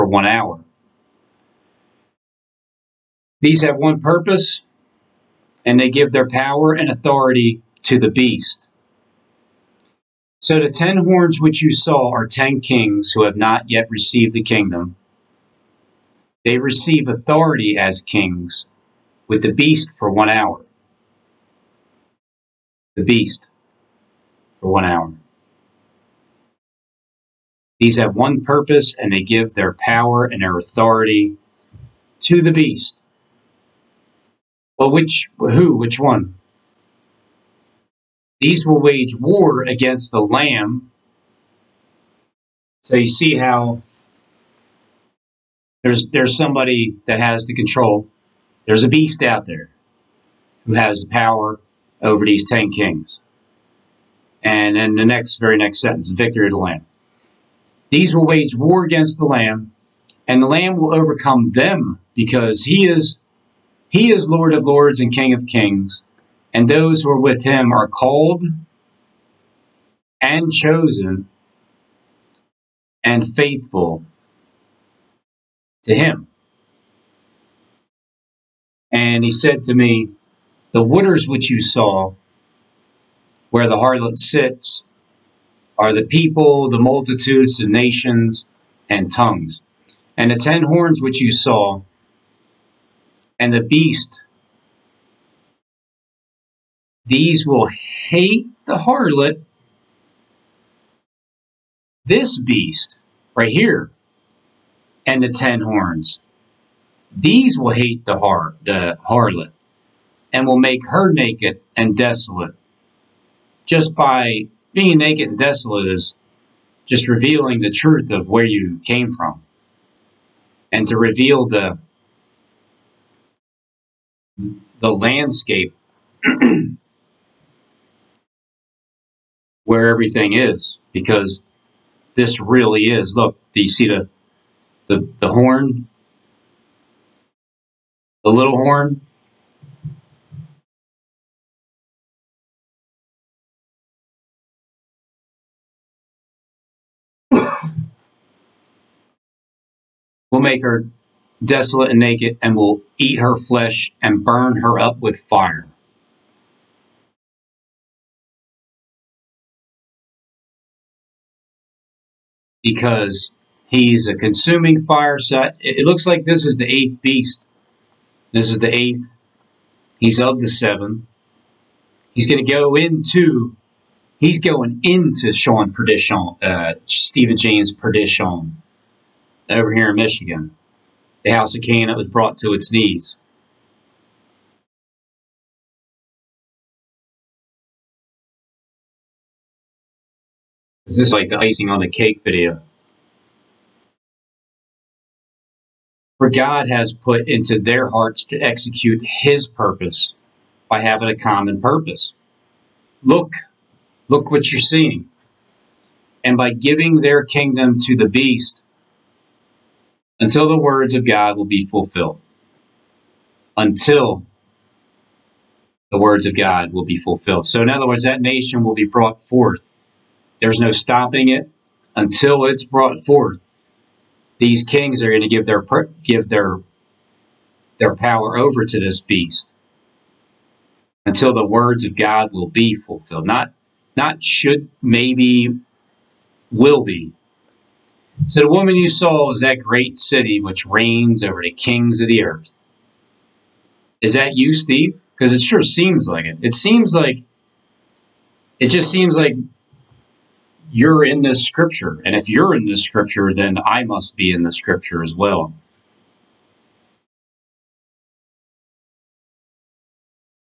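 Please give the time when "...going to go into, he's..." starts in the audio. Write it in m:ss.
2:52.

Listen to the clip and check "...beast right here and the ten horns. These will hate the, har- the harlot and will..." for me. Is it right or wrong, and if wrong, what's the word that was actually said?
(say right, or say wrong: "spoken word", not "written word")
right.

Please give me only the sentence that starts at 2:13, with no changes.
Look, do you see the, the, the horn?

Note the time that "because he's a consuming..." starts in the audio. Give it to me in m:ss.
2:42.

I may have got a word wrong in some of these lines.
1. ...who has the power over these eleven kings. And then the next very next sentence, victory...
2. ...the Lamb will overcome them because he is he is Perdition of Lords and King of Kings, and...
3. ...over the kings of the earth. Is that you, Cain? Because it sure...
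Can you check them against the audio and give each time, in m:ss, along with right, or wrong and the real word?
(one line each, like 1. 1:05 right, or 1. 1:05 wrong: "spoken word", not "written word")
1. 0:50 wrong: "ten", not "eleven"
2. 1:00 wrong: "Lord", not "Perdition"
3. 4:01 wrong: "Steve", not "Cain".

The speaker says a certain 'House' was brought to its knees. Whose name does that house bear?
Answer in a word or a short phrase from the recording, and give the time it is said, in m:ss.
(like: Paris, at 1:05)
Cain, at 3:01.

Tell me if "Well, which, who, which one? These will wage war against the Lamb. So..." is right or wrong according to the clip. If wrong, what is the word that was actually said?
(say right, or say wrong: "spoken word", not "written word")
right.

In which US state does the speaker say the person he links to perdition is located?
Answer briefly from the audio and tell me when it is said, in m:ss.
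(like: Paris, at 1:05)
Michigan, at 2:59.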